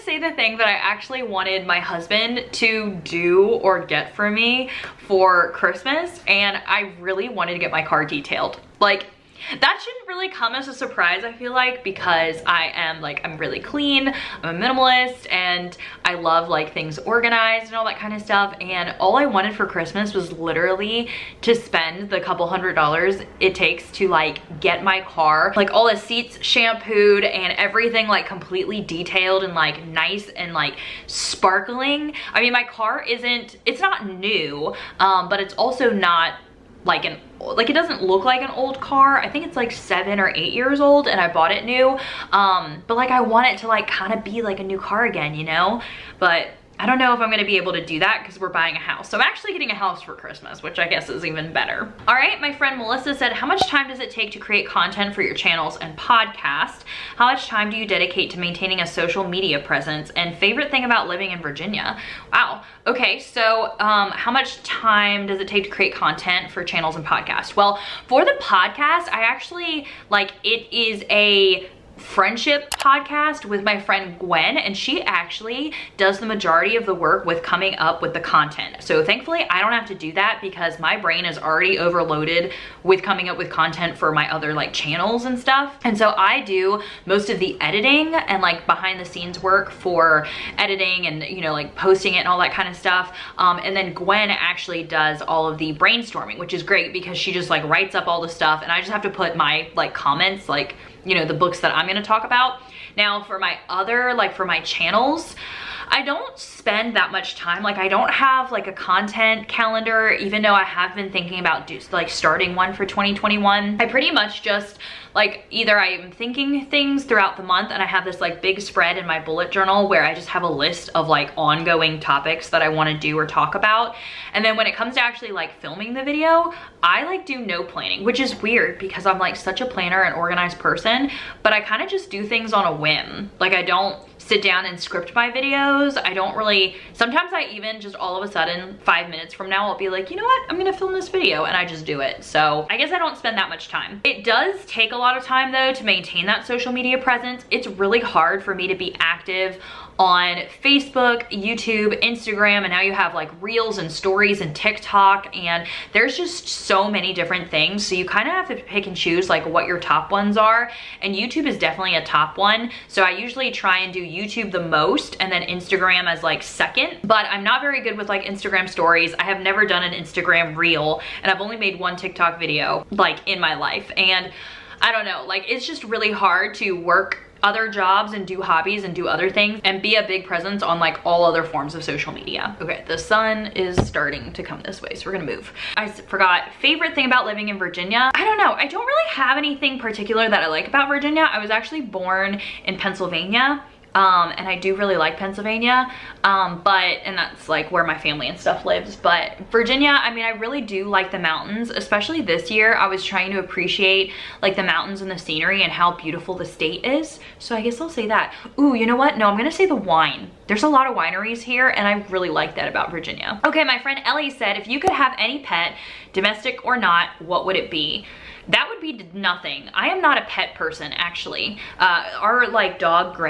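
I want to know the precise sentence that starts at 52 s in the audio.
All right, my friend Melissa said, how much time does it take to create content for your channels and podcast?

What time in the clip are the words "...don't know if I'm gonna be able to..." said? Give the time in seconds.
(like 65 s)
46 s.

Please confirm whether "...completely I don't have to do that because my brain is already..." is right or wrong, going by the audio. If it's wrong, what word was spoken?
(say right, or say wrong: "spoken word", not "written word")
wrong: "thankfully", not "completely".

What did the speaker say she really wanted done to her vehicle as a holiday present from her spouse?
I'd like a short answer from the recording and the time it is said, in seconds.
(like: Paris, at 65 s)
Car detailed, at 7 s.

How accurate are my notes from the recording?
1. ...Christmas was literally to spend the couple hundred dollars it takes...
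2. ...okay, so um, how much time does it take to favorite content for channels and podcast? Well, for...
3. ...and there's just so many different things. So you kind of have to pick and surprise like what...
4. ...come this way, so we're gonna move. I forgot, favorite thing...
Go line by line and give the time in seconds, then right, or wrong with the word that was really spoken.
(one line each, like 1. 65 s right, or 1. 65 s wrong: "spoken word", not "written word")
1. 19 s right
2. 62 s wrong: "create", not "favorite"
3. 155 s wrong: "choose", not "surprise"
4. 184 s right.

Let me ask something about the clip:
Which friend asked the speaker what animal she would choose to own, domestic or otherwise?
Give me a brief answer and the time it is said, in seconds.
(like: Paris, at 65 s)
Ellie, at 214 s.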